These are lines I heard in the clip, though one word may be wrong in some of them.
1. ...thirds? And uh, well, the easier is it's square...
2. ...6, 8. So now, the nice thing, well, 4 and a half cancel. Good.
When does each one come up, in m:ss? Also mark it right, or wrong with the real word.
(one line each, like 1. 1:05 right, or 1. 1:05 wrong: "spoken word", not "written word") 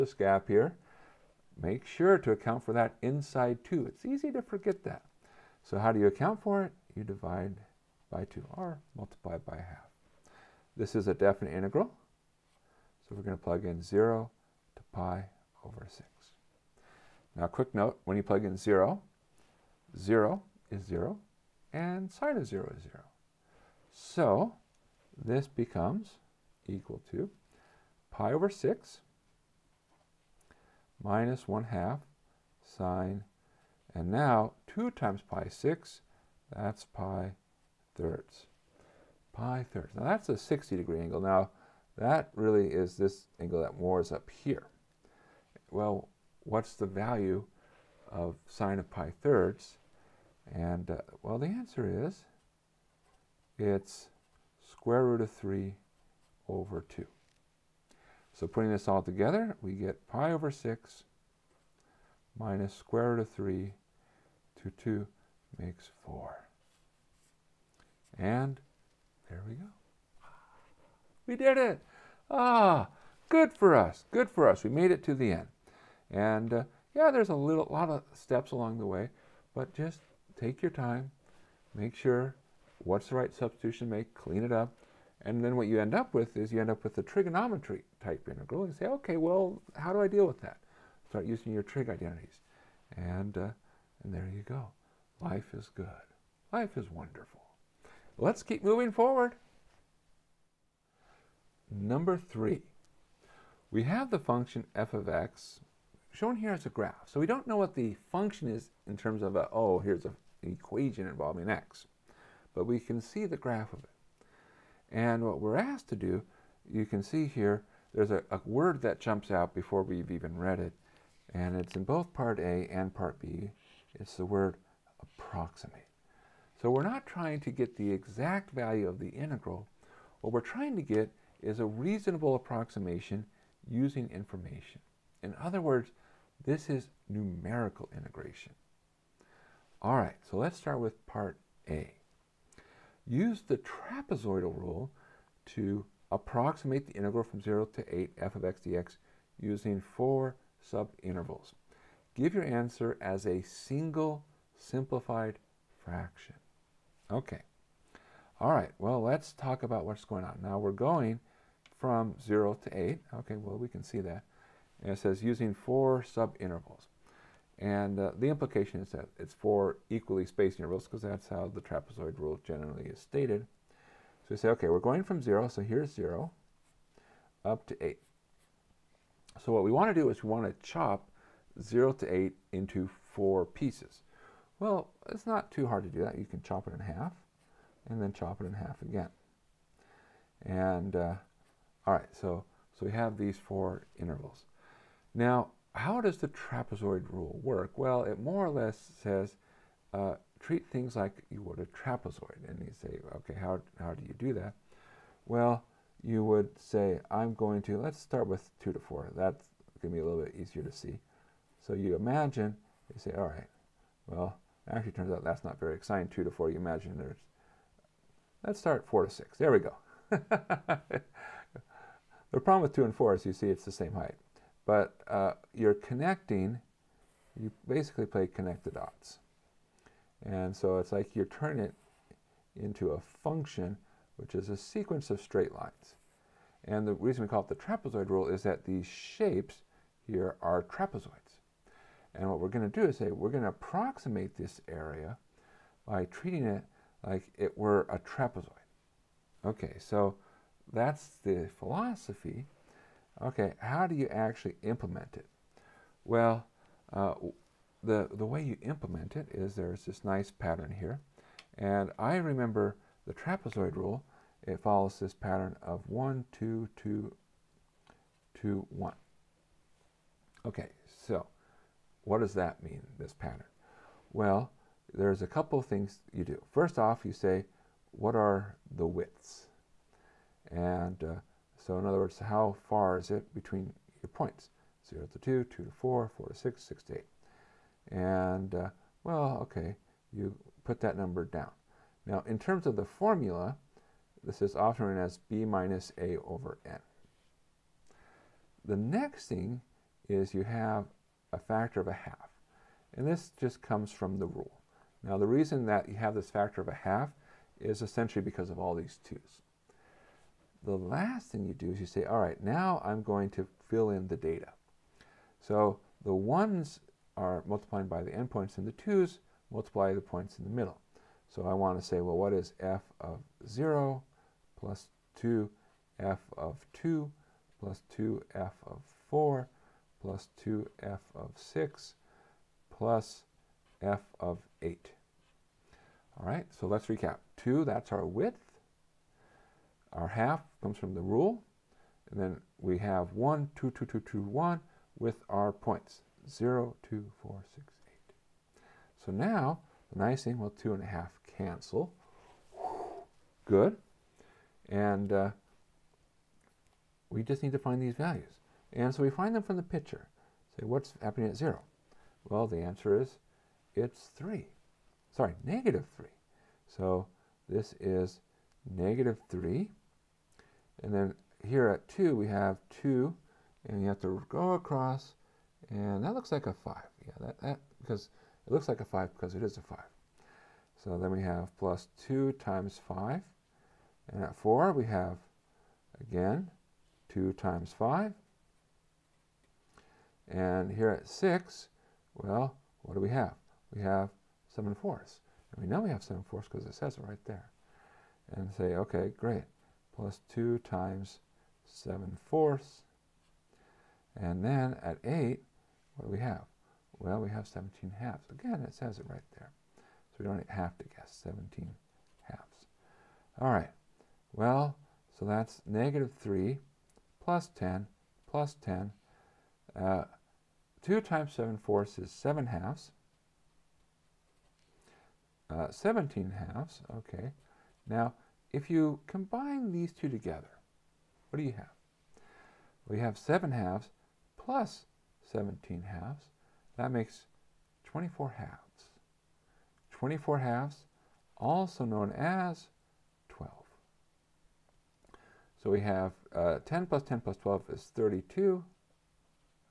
1. 0:49 wrong: "answer", not "easier"
2. 5:47 wrong: "2", not "4".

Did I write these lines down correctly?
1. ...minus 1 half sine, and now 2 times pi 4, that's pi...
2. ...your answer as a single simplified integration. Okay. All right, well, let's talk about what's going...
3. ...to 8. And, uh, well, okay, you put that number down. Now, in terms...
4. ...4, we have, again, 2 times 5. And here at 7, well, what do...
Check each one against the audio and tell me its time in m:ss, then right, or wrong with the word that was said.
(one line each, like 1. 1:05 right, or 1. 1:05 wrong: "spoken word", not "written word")
1. 0:31 wrong: "6", not "4"
2. 2:32 wrong: "fraction", not "integration"
3. 4:46 right
4. 6:24 wrong: "6", not "7".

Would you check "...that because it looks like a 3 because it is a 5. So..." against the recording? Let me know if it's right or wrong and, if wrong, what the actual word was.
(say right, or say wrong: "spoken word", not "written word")
wrong: "5", not "3".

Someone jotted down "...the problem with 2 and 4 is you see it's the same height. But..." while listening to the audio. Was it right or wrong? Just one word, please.
right.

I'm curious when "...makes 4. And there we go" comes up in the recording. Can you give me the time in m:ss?
1:05.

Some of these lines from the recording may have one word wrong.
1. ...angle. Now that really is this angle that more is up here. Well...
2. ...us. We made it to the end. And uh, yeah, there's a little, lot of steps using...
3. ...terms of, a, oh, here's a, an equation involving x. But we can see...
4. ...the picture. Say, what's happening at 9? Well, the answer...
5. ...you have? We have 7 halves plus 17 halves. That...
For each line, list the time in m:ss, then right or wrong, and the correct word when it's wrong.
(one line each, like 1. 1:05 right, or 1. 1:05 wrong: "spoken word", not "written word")
1. 0:40 right
2. 1:14 wrong: "along", not "using"
3. 1:48 right
4. 5:59 wrong: "0", not "9"
5. 7:11 right.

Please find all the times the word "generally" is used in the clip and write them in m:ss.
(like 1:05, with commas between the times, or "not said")
2:52.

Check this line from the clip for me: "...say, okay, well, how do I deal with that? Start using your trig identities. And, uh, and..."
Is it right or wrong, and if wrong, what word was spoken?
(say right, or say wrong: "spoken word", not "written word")
right.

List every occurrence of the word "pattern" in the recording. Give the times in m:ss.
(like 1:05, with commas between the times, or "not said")
4:20, 4:25, 4:33.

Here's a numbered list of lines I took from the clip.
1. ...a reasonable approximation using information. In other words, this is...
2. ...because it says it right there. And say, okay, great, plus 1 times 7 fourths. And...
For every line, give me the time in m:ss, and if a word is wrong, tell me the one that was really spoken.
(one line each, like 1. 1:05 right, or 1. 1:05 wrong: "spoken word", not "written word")
1. 2:11 right
2. 6:36 wrong: "2", not "1".